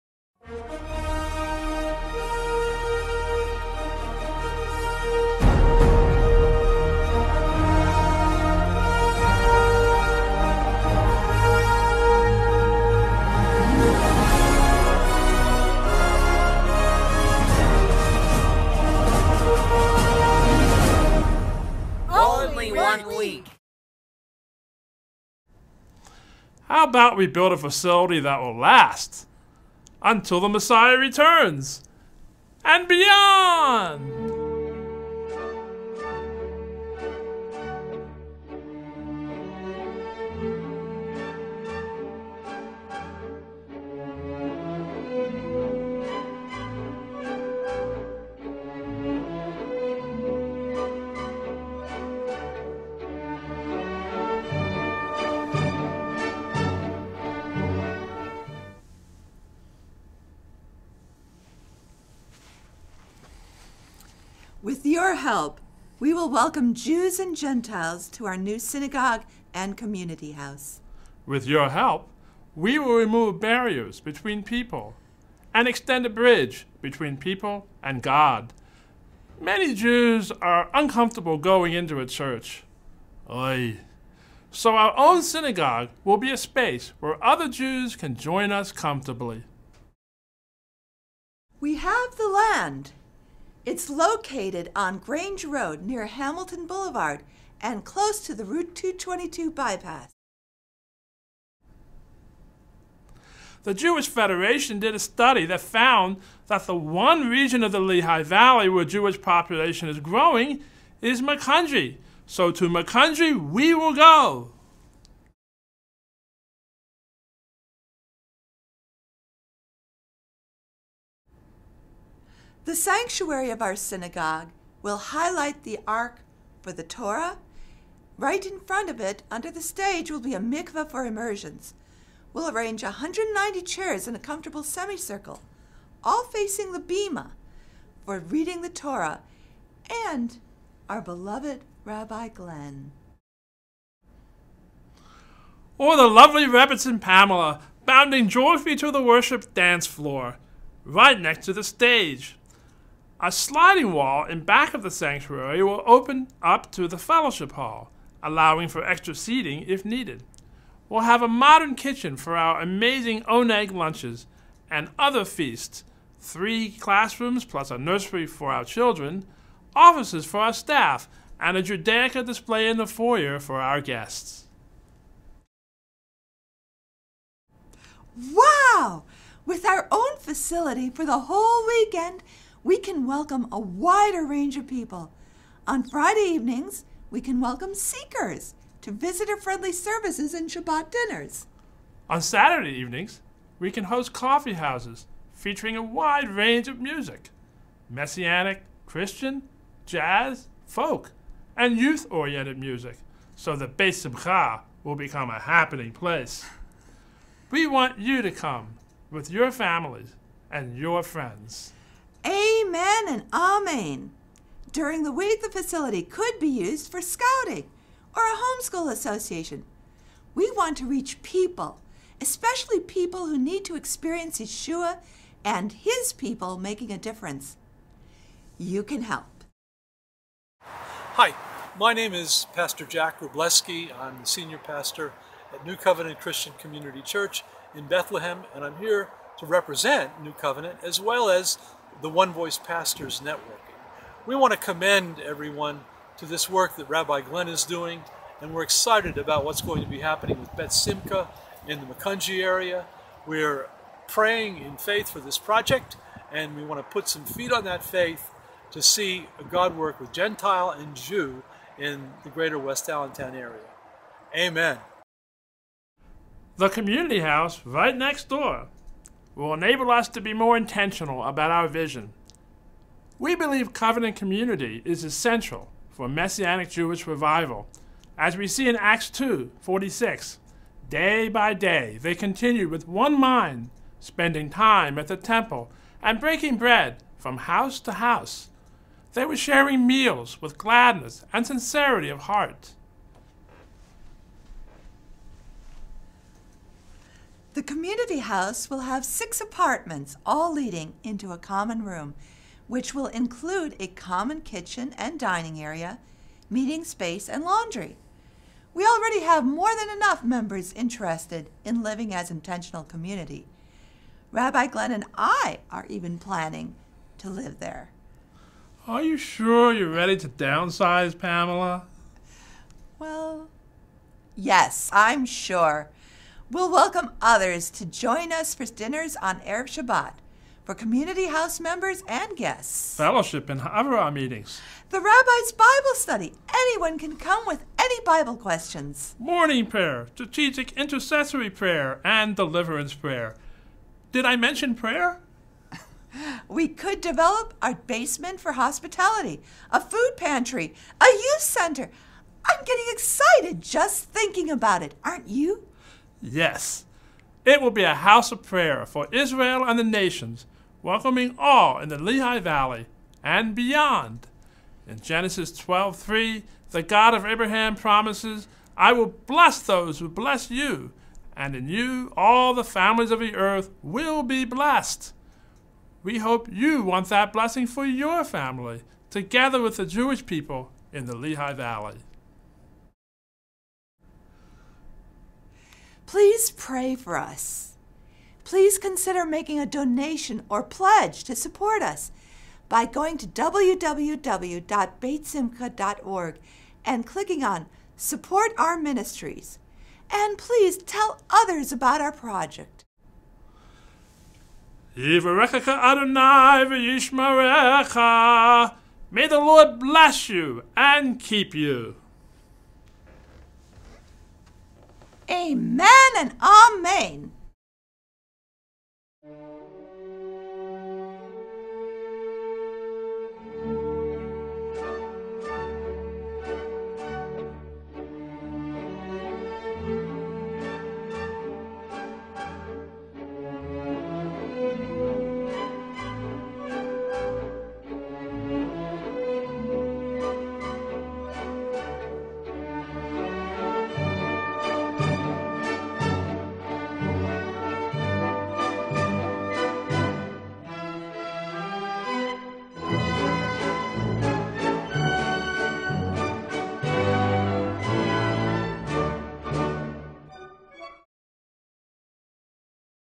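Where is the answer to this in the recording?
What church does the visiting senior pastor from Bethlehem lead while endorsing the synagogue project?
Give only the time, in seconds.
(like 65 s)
235 s.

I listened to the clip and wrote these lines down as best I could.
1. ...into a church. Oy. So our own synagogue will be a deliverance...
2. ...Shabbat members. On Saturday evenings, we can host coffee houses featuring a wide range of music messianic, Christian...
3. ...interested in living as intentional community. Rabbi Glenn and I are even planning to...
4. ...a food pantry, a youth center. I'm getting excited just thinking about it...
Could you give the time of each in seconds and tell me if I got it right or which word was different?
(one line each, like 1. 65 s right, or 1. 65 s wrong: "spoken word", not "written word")
1. 81 s wrong: "space", not "deliverance"
2. 190 s wrong: "dinners", not "members"
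3. 310 s right
4. 349 s right.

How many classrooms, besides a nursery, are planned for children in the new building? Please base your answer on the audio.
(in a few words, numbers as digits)
3.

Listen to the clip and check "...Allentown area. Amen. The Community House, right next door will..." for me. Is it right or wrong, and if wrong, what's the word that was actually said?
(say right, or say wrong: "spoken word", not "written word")
right.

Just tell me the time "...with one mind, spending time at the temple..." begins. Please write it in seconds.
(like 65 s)
282 s.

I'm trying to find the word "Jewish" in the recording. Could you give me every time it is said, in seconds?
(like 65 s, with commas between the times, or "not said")
103 s, 108 s, 276 s, 379 s.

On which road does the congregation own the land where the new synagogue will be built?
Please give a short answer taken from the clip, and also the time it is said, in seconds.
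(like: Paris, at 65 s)
Grange Road, at 94 s.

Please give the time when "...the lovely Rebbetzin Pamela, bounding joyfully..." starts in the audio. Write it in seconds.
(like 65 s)
145 s.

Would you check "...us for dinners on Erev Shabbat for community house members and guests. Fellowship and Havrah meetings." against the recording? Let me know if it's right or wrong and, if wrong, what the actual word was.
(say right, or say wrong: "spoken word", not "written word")
right.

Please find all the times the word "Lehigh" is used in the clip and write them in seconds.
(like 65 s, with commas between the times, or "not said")
107 s, 361 s, 381 s.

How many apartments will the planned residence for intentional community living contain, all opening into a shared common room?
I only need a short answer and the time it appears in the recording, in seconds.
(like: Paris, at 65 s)
6, at 299 s.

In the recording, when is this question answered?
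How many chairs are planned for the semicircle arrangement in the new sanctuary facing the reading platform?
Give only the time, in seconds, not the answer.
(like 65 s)
132 s.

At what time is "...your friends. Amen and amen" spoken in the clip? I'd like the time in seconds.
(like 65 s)
210 s.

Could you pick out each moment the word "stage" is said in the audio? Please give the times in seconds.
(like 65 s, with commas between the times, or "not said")
129 s, 151 s.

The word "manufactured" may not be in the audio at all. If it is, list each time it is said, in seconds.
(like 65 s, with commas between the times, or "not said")
not said.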